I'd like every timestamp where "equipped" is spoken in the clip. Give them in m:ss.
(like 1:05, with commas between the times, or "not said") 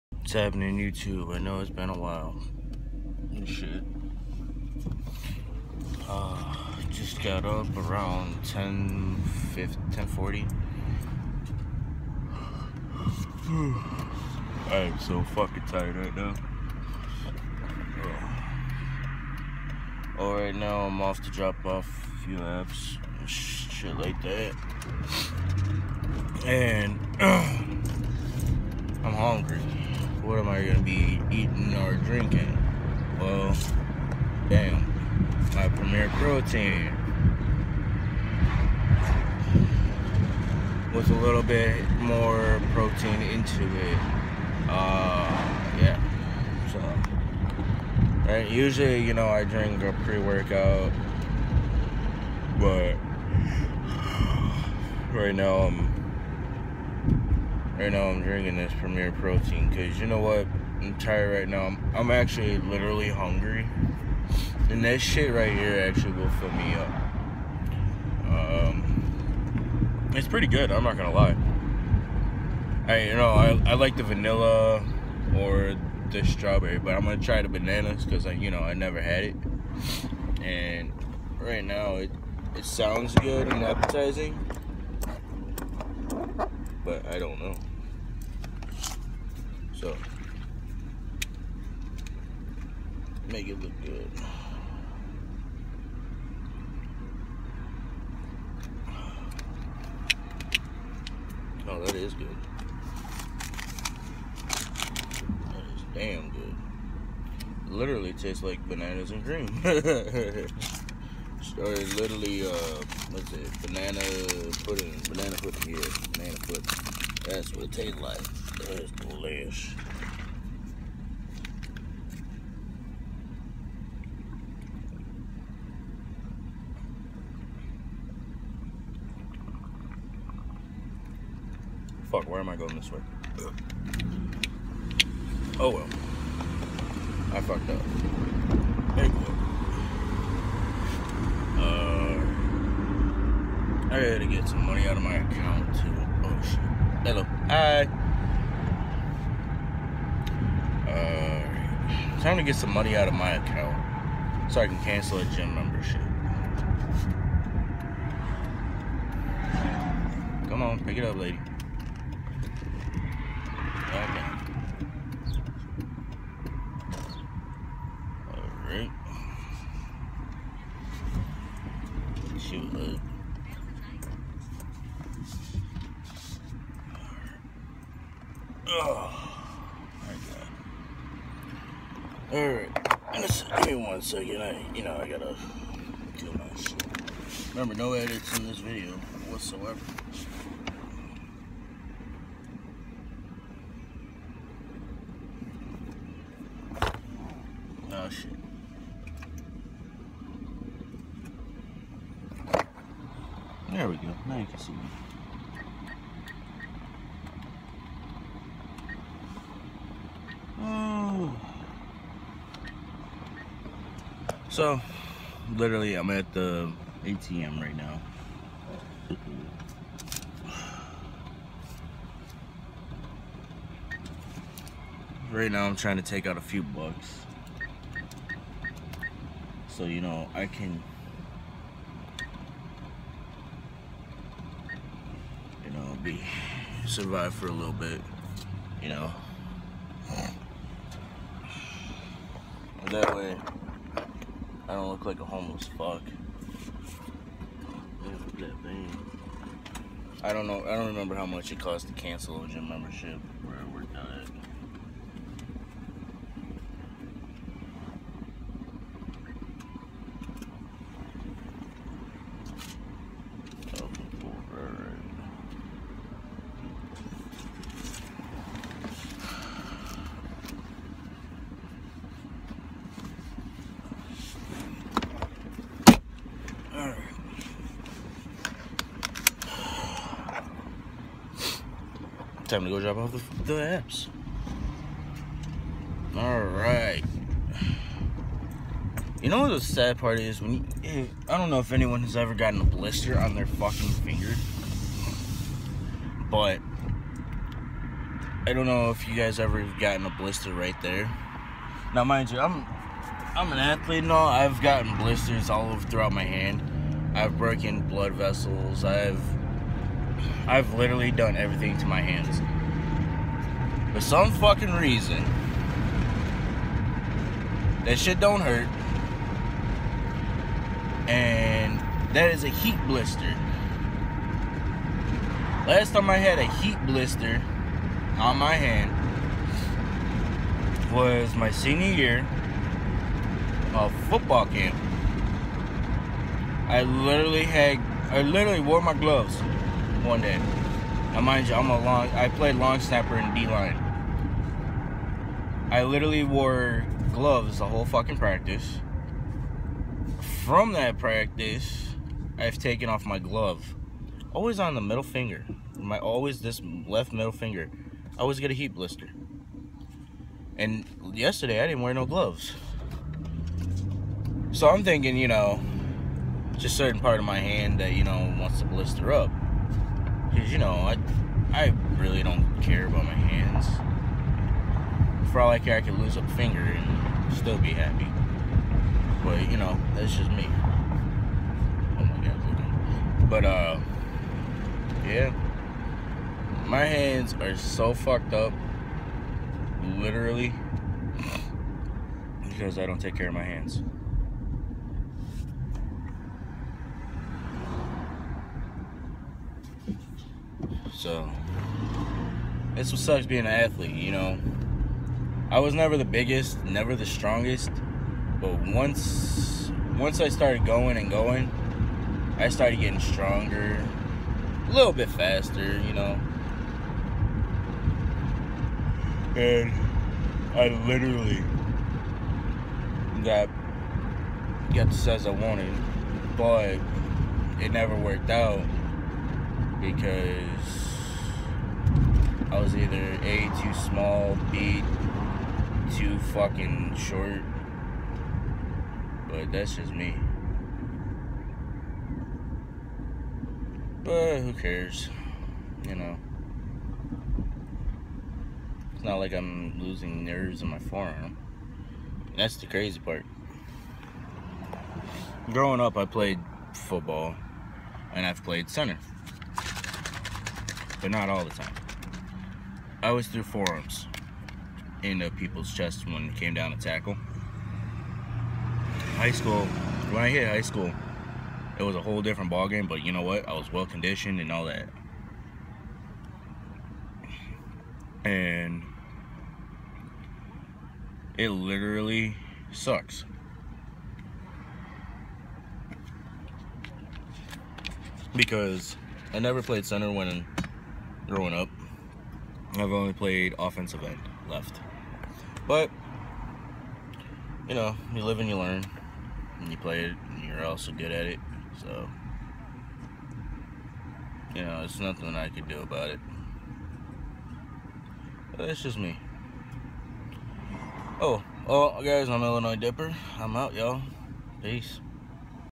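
not said.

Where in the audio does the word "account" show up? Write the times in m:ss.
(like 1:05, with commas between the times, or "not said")
2:25, 2:33.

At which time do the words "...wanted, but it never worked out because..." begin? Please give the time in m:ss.
7:05.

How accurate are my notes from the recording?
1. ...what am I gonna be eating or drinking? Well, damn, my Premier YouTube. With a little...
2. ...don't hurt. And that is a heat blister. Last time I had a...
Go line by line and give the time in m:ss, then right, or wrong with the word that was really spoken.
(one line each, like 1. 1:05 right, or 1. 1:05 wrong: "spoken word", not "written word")
1. 0:30 wrong: "Protein", not "YouTube"
2. 5:18 right.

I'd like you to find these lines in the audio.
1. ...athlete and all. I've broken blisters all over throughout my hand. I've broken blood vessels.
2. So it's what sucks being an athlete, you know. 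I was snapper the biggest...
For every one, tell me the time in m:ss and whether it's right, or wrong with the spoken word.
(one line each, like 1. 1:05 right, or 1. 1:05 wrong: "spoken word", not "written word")
1. 5:03 wrong: "gotten", not "broken"
2. 6:41 wrong: "never", not "snapper".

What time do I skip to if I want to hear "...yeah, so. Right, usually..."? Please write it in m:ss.
0:45.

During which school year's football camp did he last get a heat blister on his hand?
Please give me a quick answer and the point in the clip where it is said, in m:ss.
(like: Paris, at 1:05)
Senior year, at 5:31.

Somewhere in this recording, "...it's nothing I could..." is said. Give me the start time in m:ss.
8:24.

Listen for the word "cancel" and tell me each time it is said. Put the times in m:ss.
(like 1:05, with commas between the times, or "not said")
2:34, 4:11.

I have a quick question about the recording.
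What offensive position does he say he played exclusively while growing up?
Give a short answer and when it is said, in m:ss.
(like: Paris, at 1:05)
Offensive end left, at 8:13.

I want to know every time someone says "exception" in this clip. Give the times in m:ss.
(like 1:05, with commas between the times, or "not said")
not said.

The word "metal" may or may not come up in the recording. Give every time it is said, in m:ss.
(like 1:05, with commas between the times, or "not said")
not said.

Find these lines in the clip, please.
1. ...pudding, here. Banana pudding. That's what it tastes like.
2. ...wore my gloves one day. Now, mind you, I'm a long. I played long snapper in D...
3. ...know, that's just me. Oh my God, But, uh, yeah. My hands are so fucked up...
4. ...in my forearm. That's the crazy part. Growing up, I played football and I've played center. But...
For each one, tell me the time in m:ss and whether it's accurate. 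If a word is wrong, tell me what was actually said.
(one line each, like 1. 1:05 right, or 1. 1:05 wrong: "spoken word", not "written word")
1. 1:55 right
2. 5:38 right
3. 6:19 right
4. 7:30 right.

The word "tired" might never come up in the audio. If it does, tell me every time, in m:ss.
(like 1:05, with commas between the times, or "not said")
0:15, 1:00.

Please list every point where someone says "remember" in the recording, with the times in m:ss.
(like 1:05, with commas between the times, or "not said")
3:07, 4:10.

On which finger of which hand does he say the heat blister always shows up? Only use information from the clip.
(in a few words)
Left middle finger.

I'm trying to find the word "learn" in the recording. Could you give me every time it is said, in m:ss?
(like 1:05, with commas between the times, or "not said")
8:18.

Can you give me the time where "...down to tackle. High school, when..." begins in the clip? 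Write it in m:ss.
7:46.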